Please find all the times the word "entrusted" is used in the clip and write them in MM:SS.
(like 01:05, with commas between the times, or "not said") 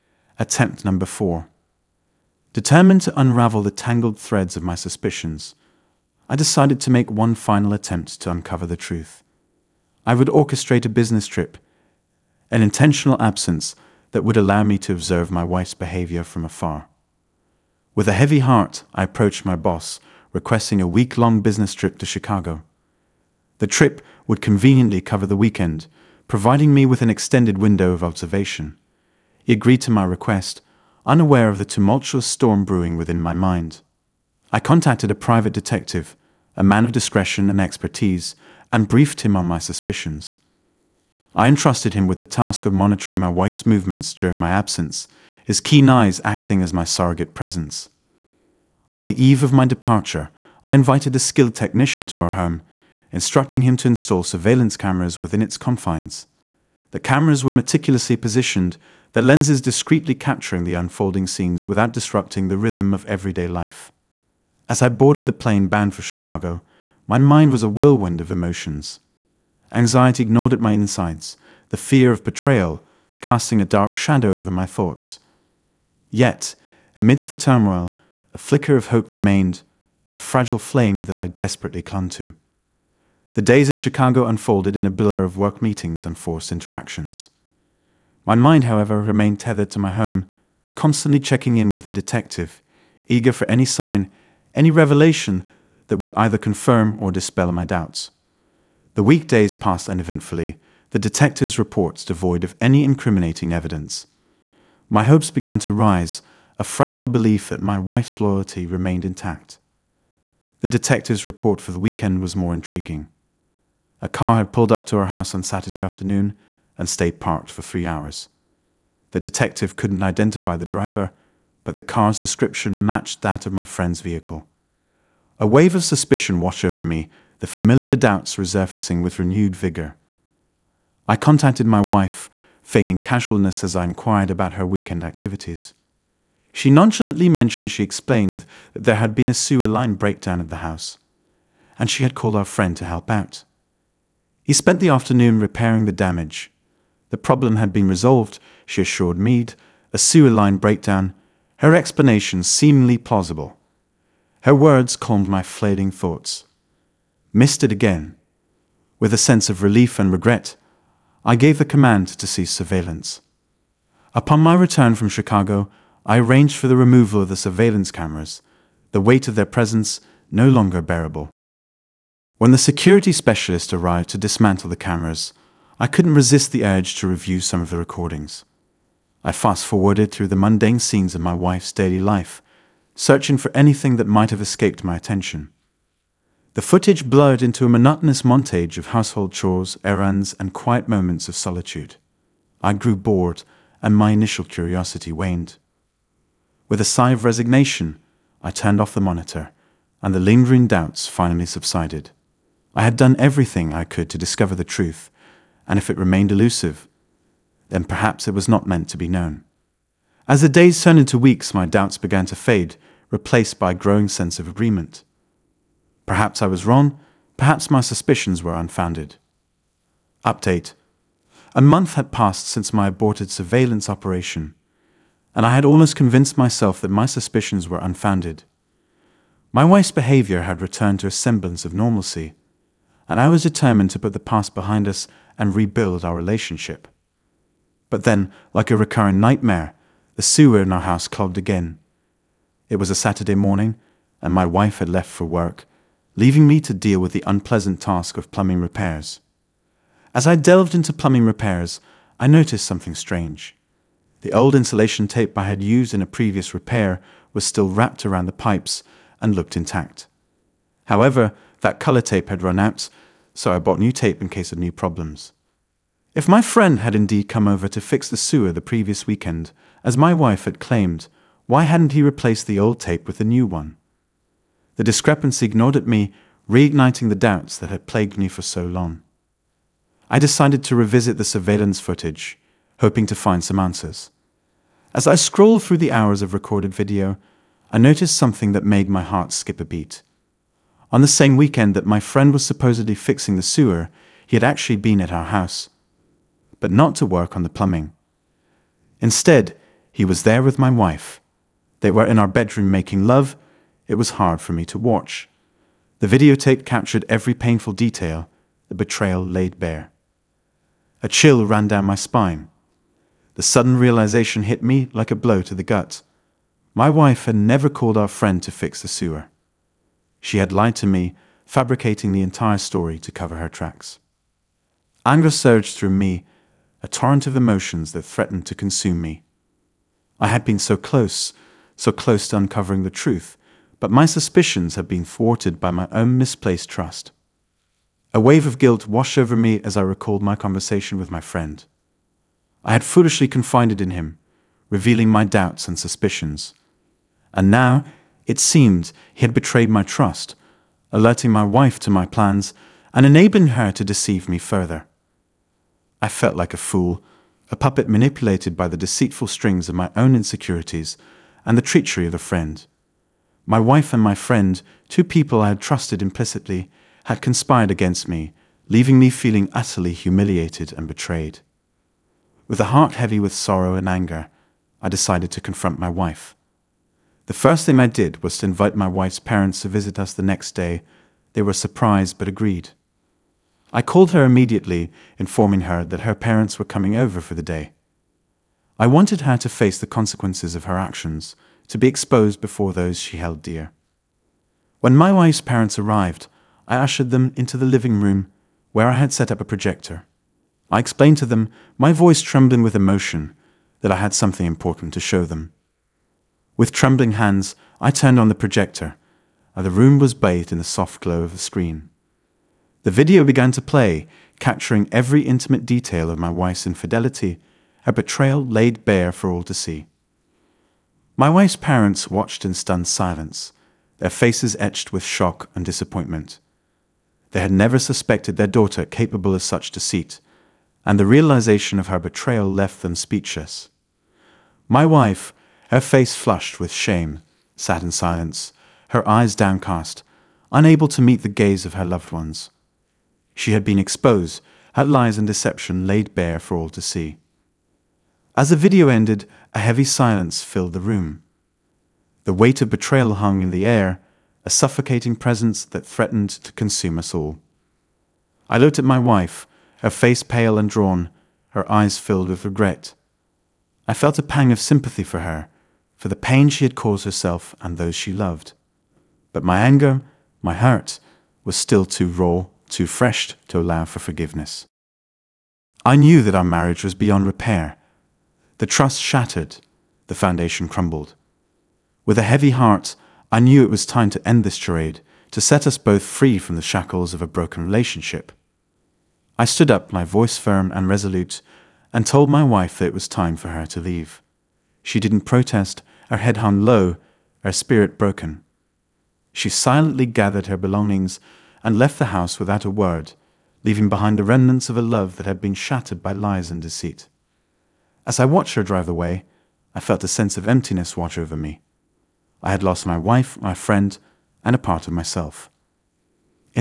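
00:41.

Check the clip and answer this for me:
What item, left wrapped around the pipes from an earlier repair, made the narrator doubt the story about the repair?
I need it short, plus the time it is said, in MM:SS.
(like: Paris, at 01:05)
insulation tape, at 04:14.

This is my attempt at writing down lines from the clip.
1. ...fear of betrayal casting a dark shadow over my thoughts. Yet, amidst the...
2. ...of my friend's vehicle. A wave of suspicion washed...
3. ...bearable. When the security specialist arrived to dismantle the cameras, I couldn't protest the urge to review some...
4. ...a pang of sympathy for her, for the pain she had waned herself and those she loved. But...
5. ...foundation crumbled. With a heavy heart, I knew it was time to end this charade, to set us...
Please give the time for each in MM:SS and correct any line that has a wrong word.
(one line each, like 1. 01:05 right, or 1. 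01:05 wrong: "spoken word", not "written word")
1. 01:11 right
2. 02:03 right
3. 02:50 wrong: "resist", not "protest"
4. 07:44 wrong: "caused", not "waned"
5. 08:00 right.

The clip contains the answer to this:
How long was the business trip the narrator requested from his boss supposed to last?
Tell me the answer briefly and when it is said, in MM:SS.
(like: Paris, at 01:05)
a week, at 00:20.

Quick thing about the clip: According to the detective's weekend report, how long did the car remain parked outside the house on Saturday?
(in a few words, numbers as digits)
3 hours.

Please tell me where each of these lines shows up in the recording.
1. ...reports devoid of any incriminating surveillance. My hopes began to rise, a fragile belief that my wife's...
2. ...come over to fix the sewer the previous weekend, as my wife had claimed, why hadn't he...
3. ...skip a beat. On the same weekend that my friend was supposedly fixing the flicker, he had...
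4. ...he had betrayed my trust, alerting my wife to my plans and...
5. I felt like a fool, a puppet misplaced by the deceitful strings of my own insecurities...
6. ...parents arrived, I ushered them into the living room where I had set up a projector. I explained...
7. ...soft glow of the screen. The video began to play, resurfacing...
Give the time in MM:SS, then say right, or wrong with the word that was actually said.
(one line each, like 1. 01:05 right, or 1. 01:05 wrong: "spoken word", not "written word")
1. 01:41 wrong: "evidence", not "surveillance"
2. 04:27 right
3. 04:49 wrong: "sewer", not "flicker"
4. 05:49 right
5. 05:55 wrong: "manipulated", not "misplaced"
6. 06:35 right
7. 06:50 wrong: "capturing", not "resurfacing".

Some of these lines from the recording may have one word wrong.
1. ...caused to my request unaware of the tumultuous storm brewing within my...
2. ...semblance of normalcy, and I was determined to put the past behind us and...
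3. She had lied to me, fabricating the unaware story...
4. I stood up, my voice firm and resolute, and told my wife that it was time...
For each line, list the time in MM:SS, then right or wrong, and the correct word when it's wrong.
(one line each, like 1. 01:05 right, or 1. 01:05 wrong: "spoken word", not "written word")
1. 00:29 wrong: "agreed", not "caused"
2. 03:51 right
3. 05:20 wrong: "entire", not "unaware"
4. 08:09 right.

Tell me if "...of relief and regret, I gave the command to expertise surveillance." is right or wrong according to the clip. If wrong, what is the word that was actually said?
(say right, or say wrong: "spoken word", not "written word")
wrong: "cease", not "expertise".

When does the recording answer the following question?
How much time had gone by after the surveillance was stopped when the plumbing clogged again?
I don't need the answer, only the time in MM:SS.
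03:41.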